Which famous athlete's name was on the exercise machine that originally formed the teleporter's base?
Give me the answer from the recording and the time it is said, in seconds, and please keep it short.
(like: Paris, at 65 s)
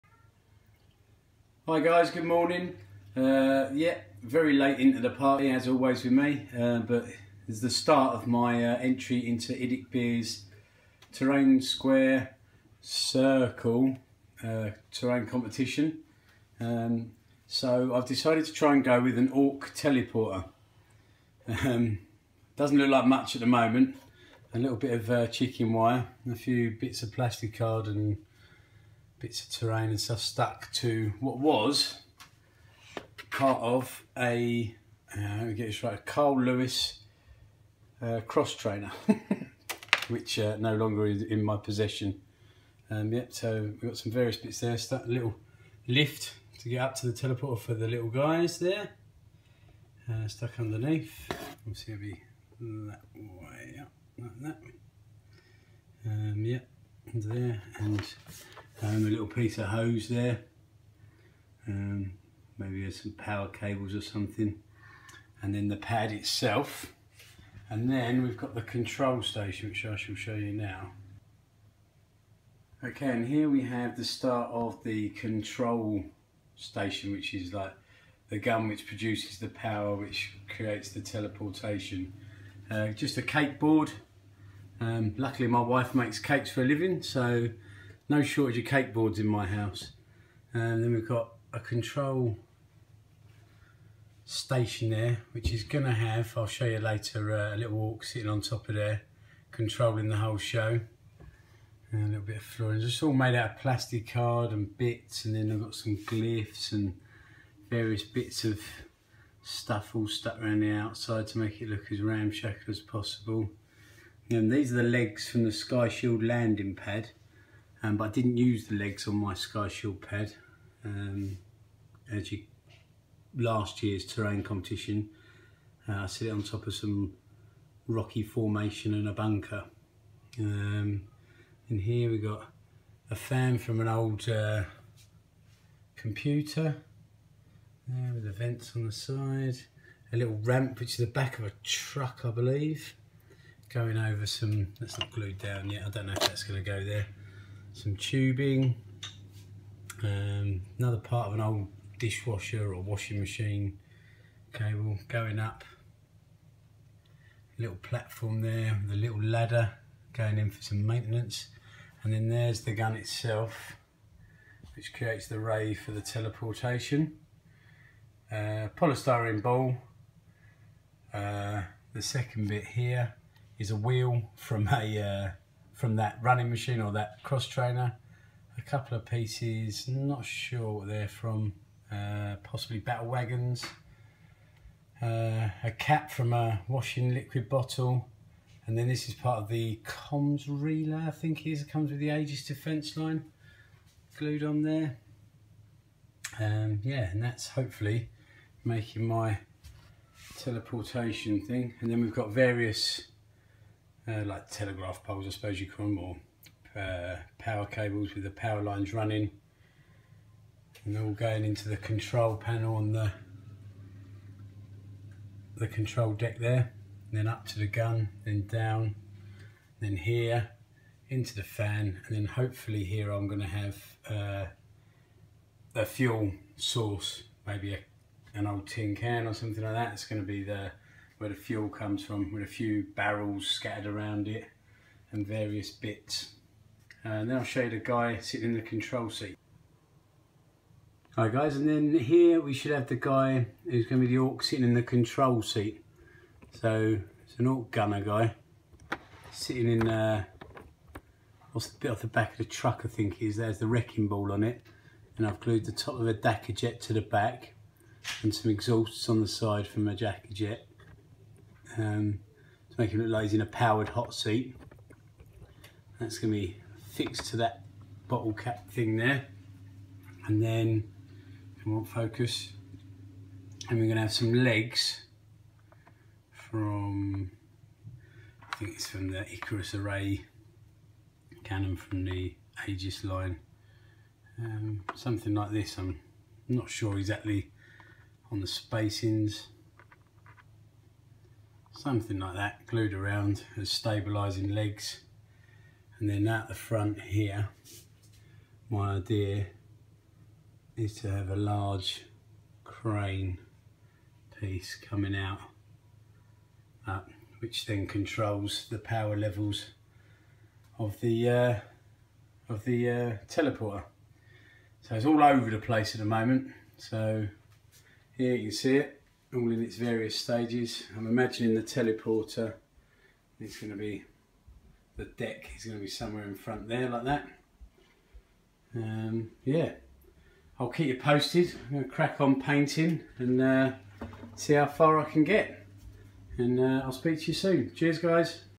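Carl Lewis, at 36 s.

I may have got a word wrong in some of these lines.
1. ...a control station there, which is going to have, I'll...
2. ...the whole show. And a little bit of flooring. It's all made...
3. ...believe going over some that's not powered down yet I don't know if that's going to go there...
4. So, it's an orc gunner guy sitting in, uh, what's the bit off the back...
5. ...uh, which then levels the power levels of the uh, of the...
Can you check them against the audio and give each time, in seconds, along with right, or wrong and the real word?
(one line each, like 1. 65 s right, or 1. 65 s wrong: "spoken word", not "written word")
1. 91 s right
2. 100 s right
3. 142 s wrong: "glued", not "powered"
4. 246 s right
5. 307 s wrong: "controls", not "levels".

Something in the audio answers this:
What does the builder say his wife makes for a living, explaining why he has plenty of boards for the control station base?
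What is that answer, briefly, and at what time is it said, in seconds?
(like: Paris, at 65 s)
Cakes, at 86 s.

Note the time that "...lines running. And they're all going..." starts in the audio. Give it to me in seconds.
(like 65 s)
208 s.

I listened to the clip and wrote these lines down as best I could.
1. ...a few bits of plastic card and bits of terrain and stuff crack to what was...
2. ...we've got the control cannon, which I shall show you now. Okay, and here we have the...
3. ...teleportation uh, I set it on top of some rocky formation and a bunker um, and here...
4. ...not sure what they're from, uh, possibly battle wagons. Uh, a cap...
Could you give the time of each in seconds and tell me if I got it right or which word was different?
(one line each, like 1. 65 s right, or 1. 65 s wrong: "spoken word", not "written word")
1. 26 s wrong: "stuck", not "crack"
2. 68 s wrong: "station", not "cannon"
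3. 124 s wrong: "competition", not "teleportation"
4. 179 s right.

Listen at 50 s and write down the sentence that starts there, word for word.
Uh, stuck underneath, obviously it'll be that way up, like that.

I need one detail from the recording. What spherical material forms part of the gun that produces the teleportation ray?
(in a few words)
Polystyrene ball.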